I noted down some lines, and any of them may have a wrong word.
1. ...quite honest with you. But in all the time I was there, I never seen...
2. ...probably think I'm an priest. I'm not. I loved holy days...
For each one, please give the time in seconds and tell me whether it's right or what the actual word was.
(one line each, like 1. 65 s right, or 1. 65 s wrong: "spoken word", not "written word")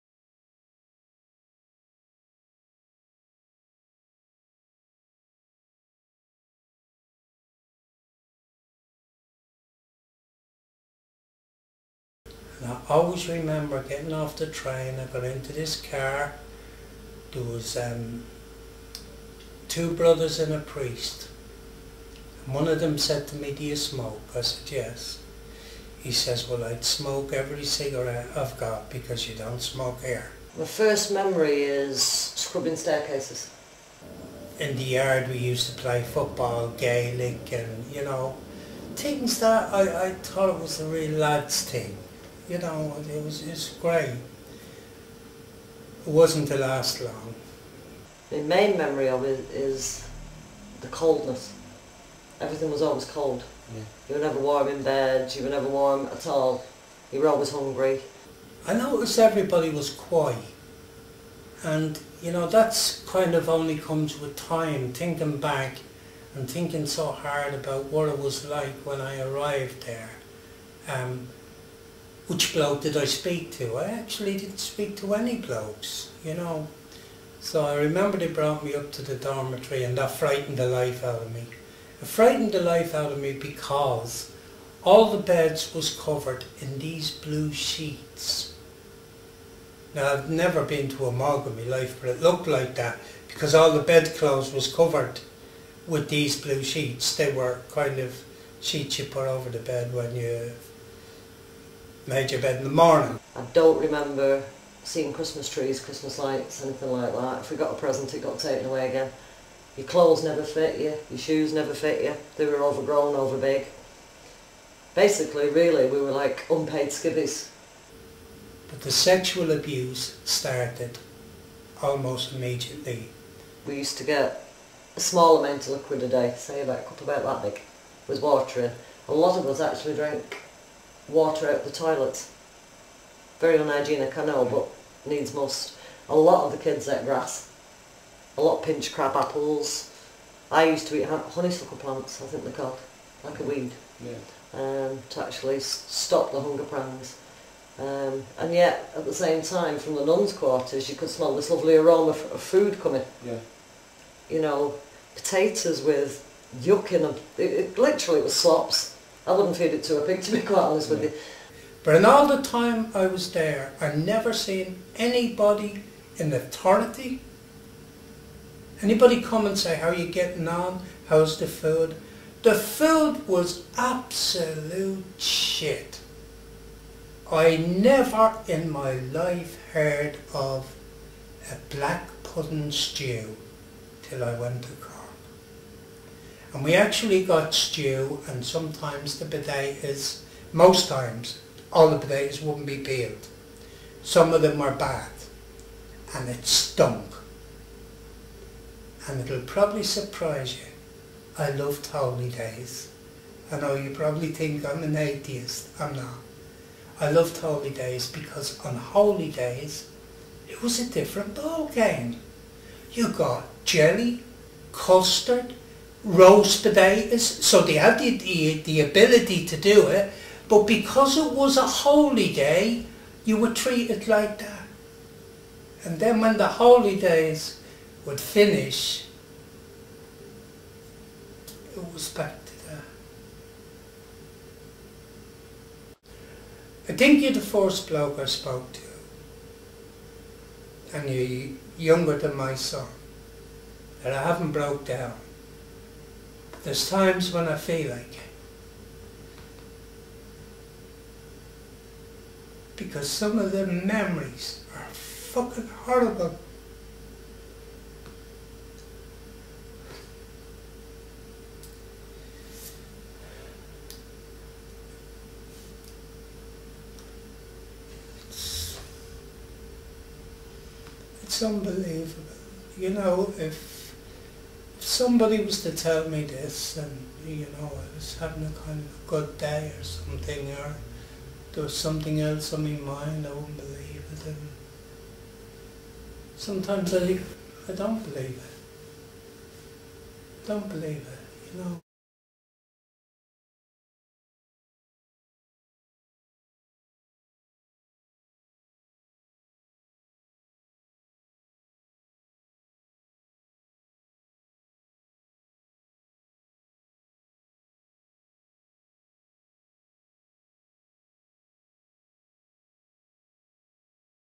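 1. 160 s right
2. 203 s wrong: "atheist", not "priest".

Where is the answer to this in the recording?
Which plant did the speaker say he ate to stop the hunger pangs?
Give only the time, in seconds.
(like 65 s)
141 s.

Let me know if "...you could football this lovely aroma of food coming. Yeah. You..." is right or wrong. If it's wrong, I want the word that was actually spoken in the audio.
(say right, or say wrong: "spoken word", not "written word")
wrong: "smell", not "football".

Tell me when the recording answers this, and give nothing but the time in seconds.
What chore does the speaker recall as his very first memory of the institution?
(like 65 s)
32 s.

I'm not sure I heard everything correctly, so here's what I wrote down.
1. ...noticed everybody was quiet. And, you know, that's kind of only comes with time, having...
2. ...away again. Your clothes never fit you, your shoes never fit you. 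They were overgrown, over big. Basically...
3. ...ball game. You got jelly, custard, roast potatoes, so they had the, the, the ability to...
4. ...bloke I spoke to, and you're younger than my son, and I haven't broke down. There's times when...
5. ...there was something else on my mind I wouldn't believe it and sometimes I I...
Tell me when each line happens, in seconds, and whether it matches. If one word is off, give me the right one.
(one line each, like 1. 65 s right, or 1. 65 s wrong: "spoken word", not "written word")
1. 58 s wrong: "thinking", not "having"
2. 108 s right
3. 211 s right
4. 237 s right
5. 281 s right.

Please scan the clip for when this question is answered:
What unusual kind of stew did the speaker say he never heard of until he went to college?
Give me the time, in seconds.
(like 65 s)
181 s.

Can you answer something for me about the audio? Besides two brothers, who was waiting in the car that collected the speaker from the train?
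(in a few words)
a priest.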